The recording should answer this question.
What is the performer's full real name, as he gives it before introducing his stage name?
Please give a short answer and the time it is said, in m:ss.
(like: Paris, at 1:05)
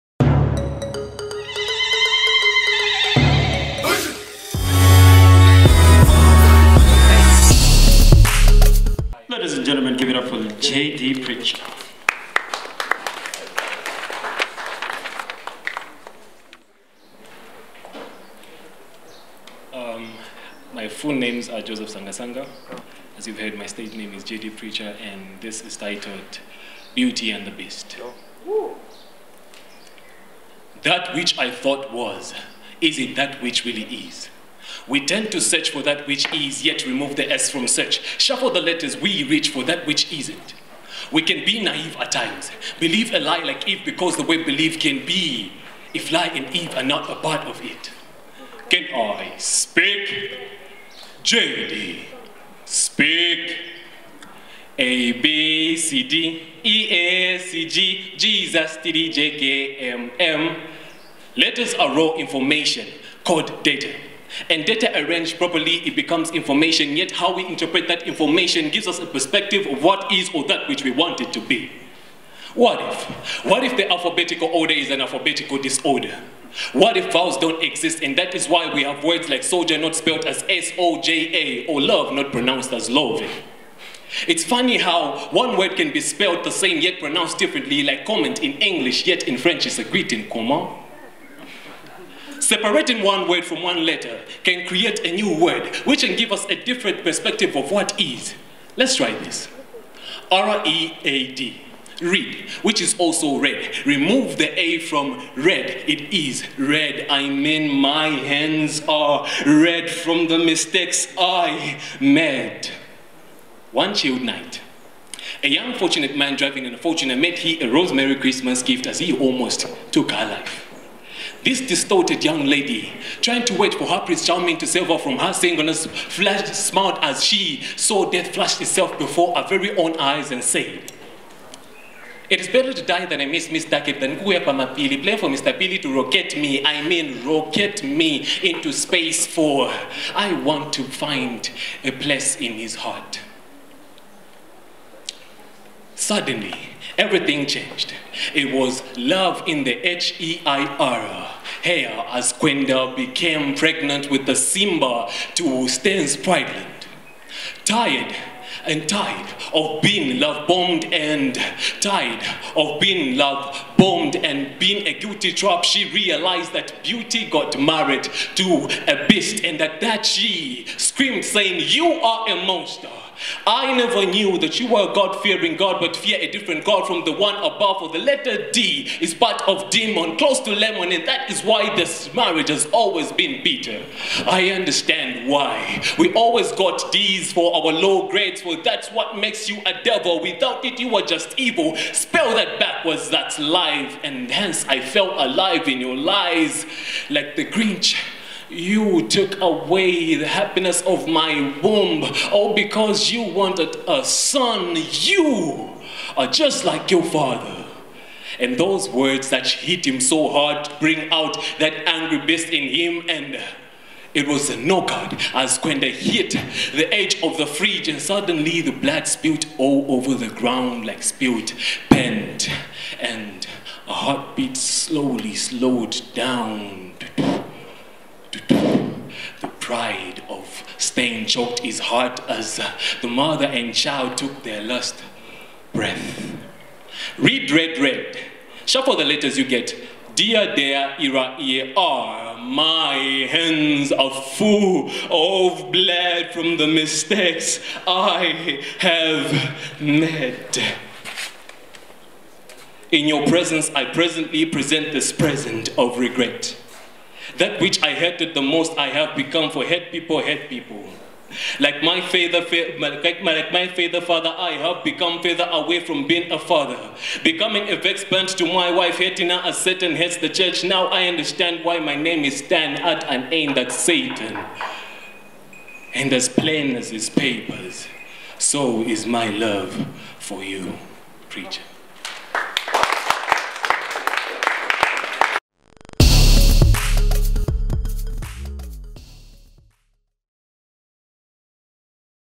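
Joseph Sangasanga, at 0:21.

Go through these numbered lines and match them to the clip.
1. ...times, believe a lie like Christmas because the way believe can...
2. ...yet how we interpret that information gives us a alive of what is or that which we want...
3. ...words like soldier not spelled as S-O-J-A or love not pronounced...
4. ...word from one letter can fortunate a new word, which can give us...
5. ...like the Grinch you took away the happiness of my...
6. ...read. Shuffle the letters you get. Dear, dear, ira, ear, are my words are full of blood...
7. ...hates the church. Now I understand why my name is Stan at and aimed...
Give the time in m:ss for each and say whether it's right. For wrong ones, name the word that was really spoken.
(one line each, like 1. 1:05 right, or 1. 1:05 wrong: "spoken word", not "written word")
1. 0:42 wrong: "Eve", not "Christmas"
2. 1:06 wrong: "perspective", not "alive"
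3. 1:19 right
4. 1:33 wrong: "create", not "fortunate"
5. 3:17 right
6. 3:57 wrong: "hands", not "words"
7. 4:29 right.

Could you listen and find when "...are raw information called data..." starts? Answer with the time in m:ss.
1:01.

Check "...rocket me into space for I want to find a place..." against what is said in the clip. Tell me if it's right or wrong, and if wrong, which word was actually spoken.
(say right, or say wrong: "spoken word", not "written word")
right.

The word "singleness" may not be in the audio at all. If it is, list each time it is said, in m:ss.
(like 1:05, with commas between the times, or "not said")
2:05.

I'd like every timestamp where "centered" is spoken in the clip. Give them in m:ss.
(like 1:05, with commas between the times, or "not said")
not said.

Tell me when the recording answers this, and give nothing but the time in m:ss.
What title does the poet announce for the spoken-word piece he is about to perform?
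0:26.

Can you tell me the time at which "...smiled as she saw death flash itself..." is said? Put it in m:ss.
2:06.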